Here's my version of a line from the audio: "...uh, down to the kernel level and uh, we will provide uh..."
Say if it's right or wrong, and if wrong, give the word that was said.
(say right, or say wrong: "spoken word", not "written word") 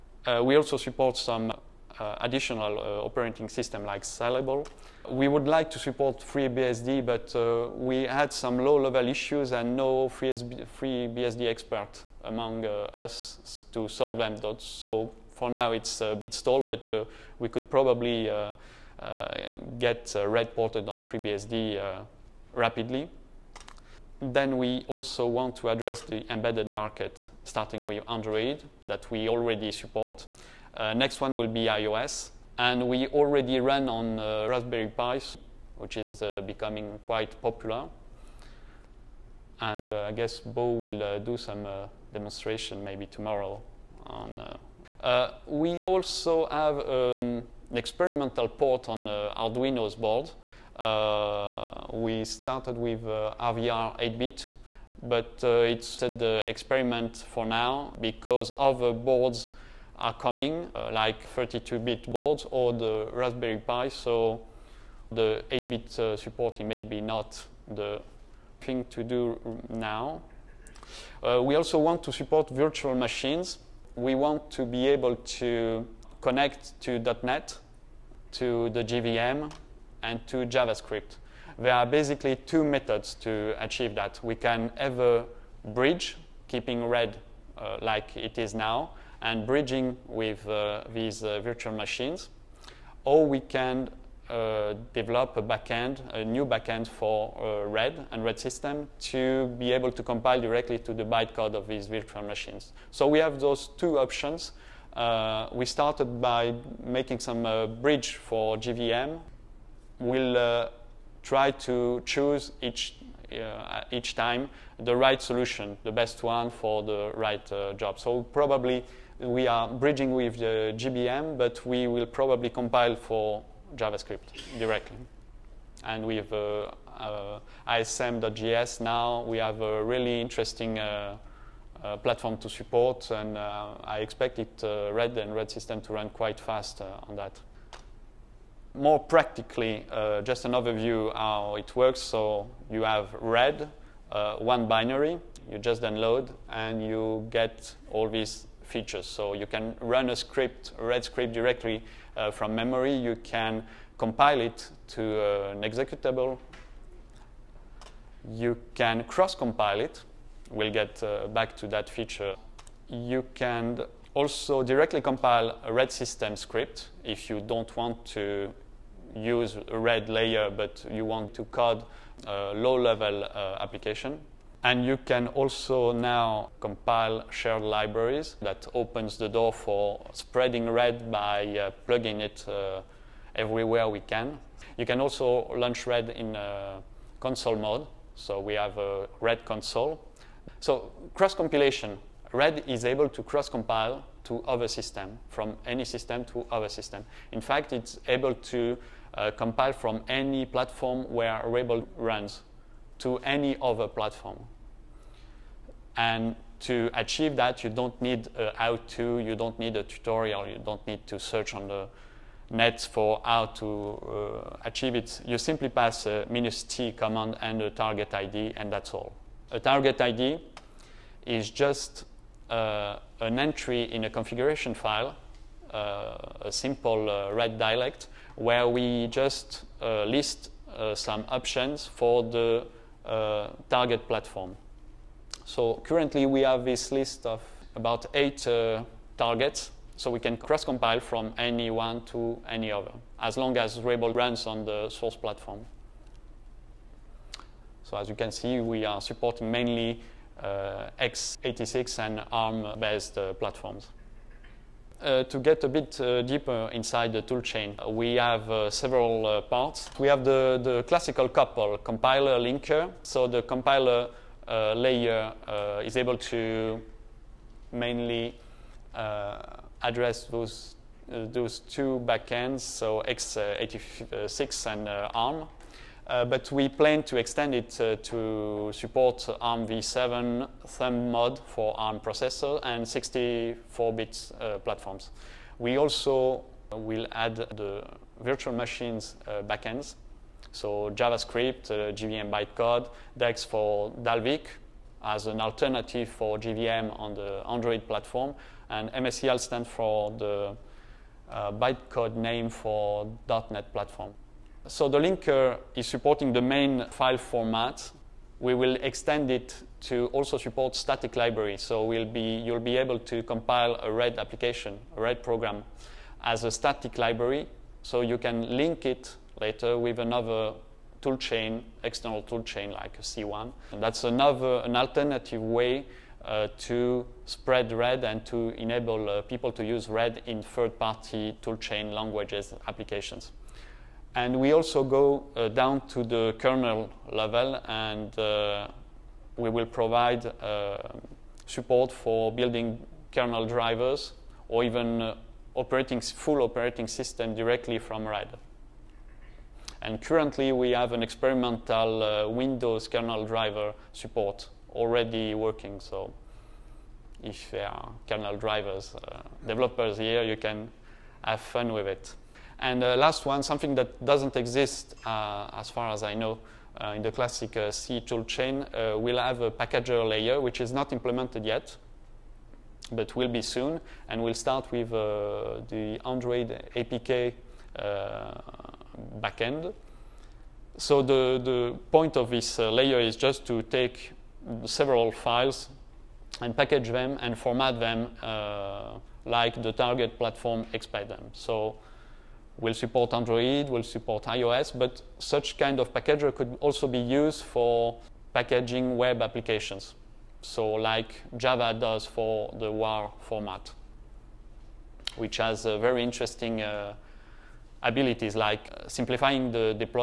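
right.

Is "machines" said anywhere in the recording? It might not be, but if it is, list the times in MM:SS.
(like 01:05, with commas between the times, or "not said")
01:12, 01:31, 01:42, 04:48.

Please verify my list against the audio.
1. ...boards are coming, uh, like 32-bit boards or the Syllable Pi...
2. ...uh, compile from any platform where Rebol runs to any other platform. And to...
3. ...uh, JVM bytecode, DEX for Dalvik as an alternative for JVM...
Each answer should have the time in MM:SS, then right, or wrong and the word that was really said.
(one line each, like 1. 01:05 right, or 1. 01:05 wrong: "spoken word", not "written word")
1. 00:58 wrong: "Raspberry", not "Syllable"
2. 03:19 right
3. 04:51 right.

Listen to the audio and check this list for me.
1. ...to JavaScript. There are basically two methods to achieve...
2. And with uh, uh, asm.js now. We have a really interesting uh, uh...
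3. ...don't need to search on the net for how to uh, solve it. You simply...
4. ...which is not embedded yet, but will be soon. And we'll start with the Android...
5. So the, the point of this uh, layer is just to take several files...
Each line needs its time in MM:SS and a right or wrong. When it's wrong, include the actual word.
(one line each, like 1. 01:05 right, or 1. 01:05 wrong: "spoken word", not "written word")
1. 01:20 right
2. 02:05 right
3. 03:30 wrong: "achieve", not "solve"
4. 06:10 wrong: "implemented", not "embedded"
5. 06:20 right.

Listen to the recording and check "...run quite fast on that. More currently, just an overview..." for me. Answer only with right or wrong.
wrong.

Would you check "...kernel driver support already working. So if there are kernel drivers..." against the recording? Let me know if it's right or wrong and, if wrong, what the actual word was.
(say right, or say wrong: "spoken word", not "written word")
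right.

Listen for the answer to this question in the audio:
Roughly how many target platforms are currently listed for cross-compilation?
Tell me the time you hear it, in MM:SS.
03:58.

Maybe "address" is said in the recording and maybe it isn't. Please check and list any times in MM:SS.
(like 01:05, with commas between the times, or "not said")
00:25, 04:29.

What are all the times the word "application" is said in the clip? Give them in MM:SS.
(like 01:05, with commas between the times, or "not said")
02:53, 05:14, 05:32, 06:39.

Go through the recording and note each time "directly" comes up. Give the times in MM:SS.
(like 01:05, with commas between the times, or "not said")
01:40, 02:04, 02:31, 02:44, 05:47.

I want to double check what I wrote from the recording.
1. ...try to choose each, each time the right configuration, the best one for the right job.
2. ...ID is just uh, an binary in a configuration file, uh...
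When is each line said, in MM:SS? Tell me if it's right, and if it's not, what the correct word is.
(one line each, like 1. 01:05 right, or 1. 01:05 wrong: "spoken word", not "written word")
1. 01:51 wrong: "solution", not "configuration"
2. 03:39 wrong: "entry", not "binary".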